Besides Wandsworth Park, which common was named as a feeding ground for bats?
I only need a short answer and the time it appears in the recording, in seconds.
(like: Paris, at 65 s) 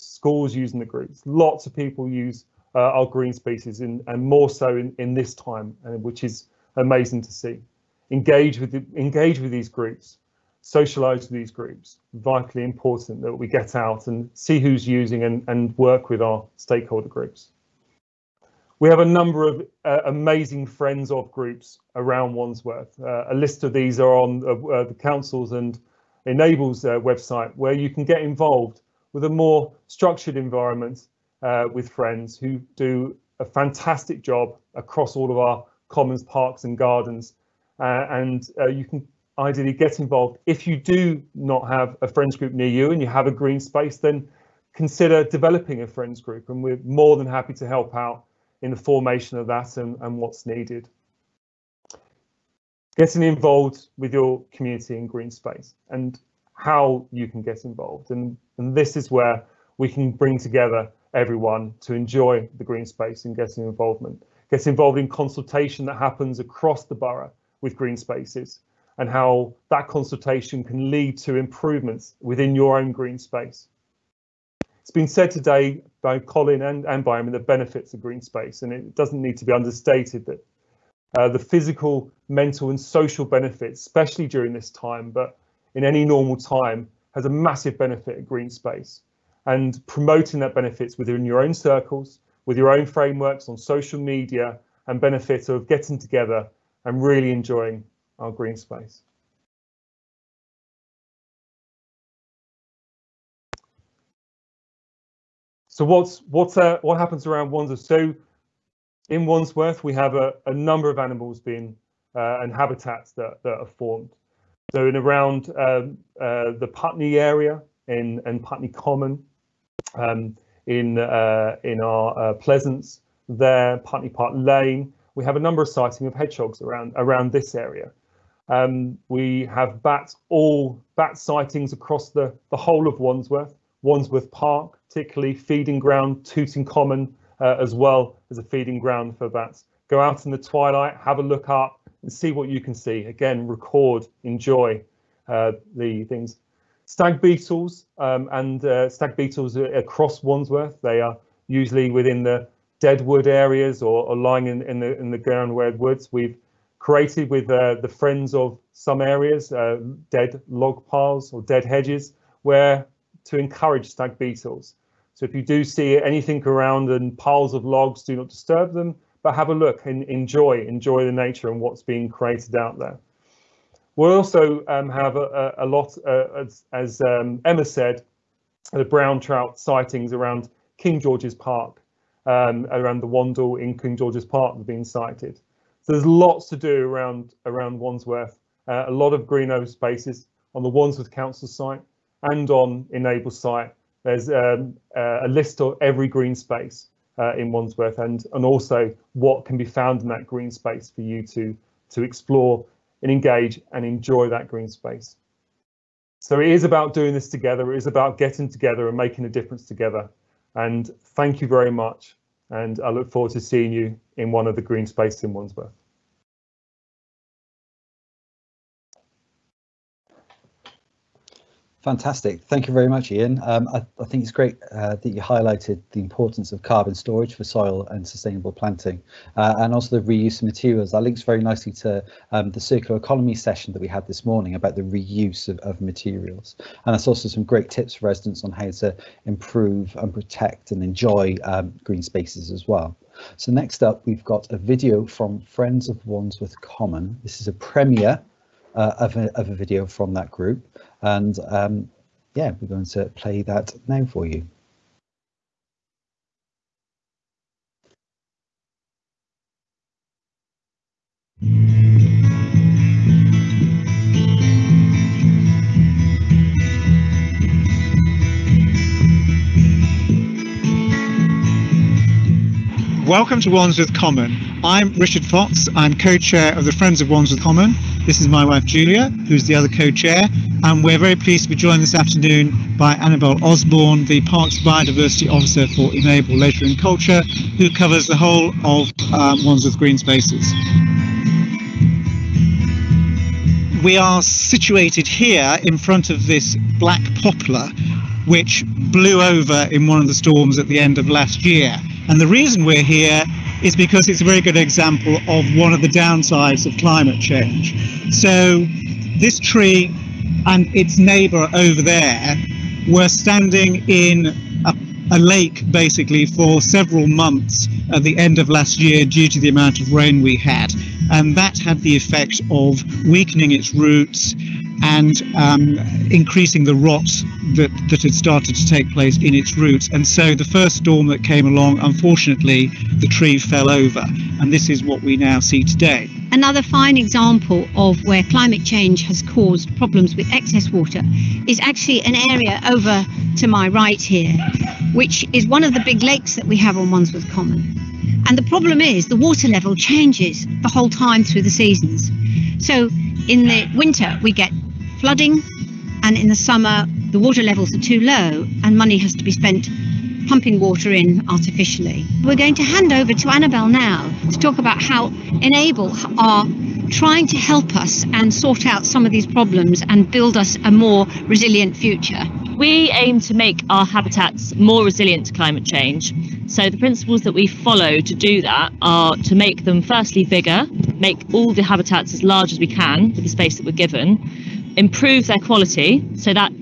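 Tooting Common, at 136 s.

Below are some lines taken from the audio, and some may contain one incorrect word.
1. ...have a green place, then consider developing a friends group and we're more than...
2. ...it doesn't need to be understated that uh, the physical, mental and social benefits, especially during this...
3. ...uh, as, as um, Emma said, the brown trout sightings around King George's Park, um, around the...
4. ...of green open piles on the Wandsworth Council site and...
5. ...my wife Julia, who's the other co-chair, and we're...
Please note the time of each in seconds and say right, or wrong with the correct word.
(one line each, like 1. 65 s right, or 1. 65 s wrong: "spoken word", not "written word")
1. 43 s wrong: "space", not "place"
2. 78 s right
3. 176 s right
4. 189 s wrong: "spaces", not "piles"
5. 278 s right.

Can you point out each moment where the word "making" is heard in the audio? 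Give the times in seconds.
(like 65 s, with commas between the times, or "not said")
208 s.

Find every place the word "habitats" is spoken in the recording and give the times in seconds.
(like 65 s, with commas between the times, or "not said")
112 s, 373 s, 381 s.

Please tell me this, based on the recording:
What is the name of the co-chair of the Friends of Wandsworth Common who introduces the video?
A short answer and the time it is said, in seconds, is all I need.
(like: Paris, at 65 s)
Richard Fox, at 274 s.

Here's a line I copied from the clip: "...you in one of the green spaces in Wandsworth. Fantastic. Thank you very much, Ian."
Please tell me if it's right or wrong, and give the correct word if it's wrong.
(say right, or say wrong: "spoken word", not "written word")
right.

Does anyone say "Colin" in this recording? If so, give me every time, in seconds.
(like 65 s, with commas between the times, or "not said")
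76 s.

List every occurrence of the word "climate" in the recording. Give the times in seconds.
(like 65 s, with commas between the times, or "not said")
306 s, 338 s, 375 s.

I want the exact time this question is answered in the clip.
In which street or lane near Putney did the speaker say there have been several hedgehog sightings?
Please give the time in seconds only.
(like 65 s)
123 s.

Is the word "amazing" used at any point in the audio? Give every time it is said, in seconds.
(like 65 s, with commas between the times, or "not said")
6 s, 20 s.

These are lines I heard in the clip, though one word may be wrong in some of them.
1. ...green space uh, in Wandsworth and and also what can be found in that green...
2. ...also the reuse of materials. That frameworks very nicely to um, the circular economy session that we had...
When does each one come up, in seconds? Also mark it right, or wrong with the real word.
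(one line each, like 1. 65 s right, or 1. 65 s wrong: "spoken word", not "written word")
1. 196 s right
2. 229 s wrong: "links", not "frameworks".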